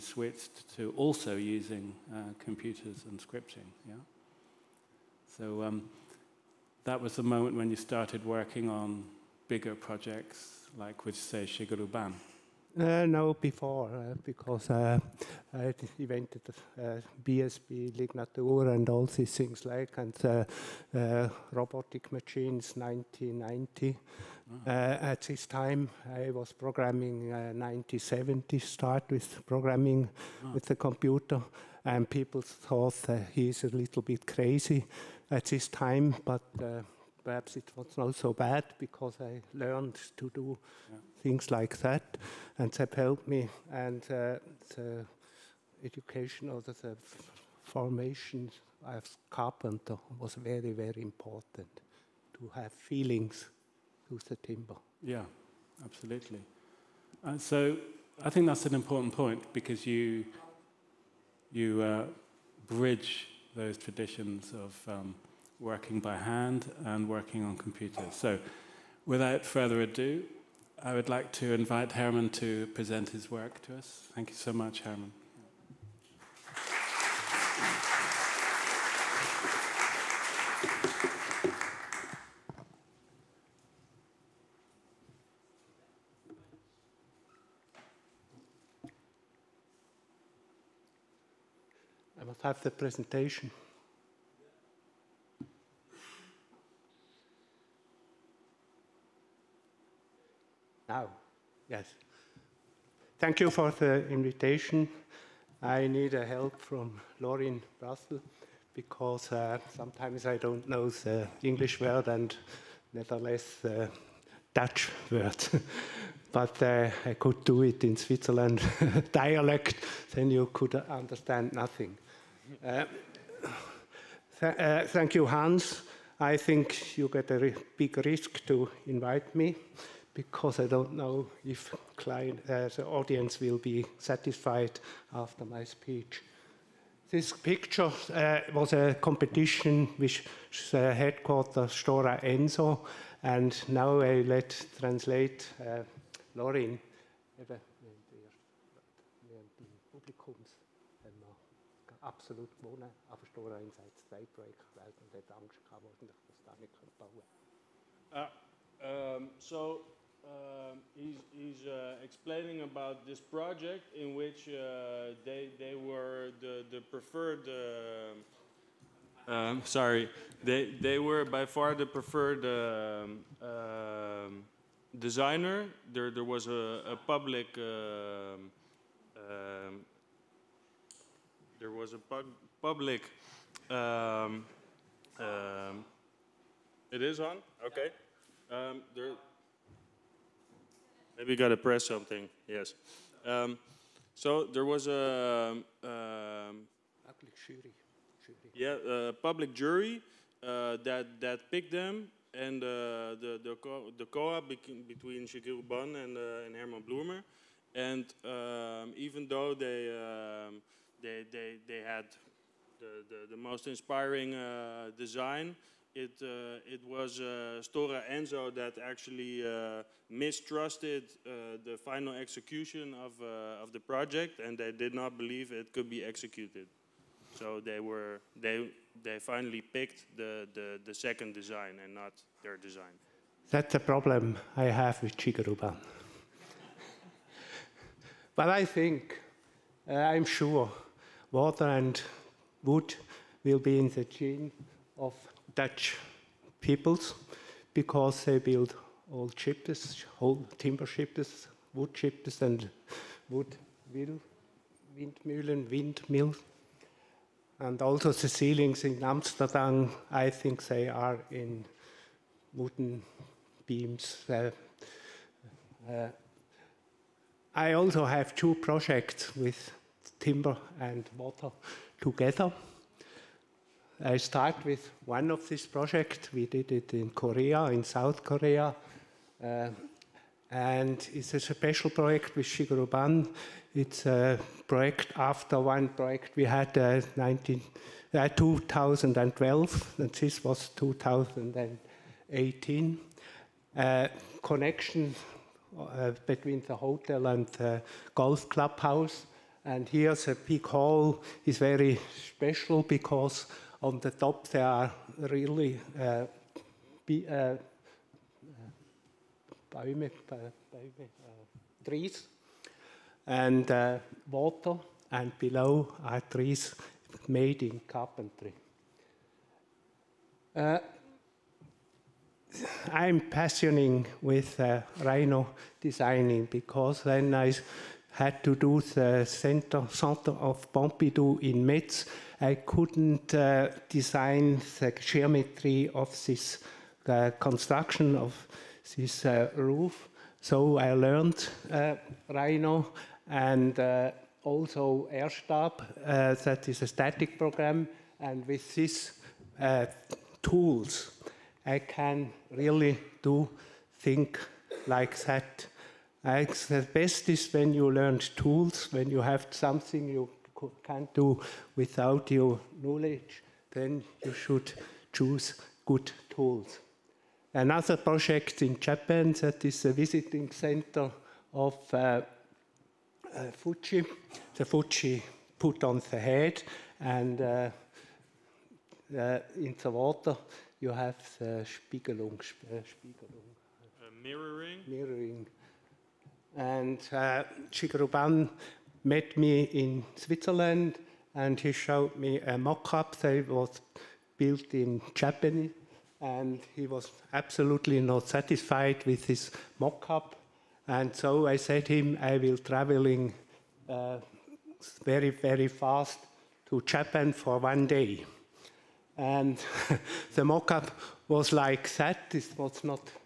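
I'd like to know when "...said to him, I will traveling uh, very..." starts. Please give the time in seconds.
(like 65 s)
401 s.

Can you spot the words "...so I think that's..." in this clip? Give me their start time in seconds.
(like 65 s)
57 s.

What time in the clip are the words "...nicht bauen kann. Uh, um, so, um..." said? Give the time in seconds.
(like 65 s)
156 s.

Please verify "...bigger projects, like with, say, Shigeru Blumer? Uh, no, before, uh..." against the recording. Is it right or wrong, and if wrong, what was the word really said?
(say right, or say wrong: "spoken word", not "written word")
wrong: "Ban", not "Blumer".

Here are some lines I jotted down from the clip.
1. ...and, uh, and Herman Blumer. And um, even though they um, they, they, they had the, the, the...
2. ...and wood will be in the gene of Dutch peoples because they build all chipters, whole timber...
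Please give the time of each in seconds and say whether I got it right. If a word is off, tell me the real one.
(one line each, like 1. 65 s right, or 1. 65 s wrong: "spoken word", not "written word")
1. 205 s right
2. 241 s right.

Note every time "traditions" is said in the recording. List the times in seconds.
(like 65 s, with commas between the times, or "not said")
63 s.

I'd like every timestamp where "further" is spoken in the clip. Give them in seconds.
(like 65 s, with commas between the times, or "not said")
69 s.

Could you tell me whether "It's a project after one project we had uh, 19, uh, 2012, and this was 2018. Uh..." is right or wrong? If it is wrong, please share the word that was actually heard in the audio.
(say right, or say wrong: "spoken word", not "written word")
right.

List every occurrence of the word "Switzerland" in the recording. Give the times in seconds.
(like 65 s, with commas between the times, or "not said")
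117 s, 390 s.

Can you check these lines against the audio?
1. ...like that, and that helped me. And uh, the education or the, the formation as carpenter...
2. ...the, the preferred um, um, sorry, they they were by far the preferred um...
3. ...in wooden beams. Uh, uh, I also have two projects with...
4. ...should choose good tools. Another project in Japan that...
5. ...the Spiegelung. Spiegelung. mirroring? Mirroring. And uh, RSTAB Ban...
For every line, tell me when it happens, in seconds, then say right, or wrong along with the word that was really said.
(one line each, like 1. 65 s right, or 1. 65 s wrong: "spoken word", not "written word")
1. 41 s right
2. 166 s right
3. 261 s right
4. 364 s right
5. 381 s wrong: "Shigeru", not "RSTAB".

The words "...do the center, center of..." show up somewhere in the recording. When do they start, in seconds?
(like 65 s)
328 s.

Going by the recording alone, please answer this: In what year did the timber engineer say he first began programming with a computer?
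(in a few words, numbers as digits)
1970.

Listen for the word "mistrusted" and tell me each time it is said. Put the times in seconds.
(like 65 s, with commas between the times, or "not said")
220 s.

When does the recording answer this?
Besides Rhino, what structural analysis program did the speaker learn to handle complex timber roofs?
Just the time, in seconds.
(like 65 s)
345 s.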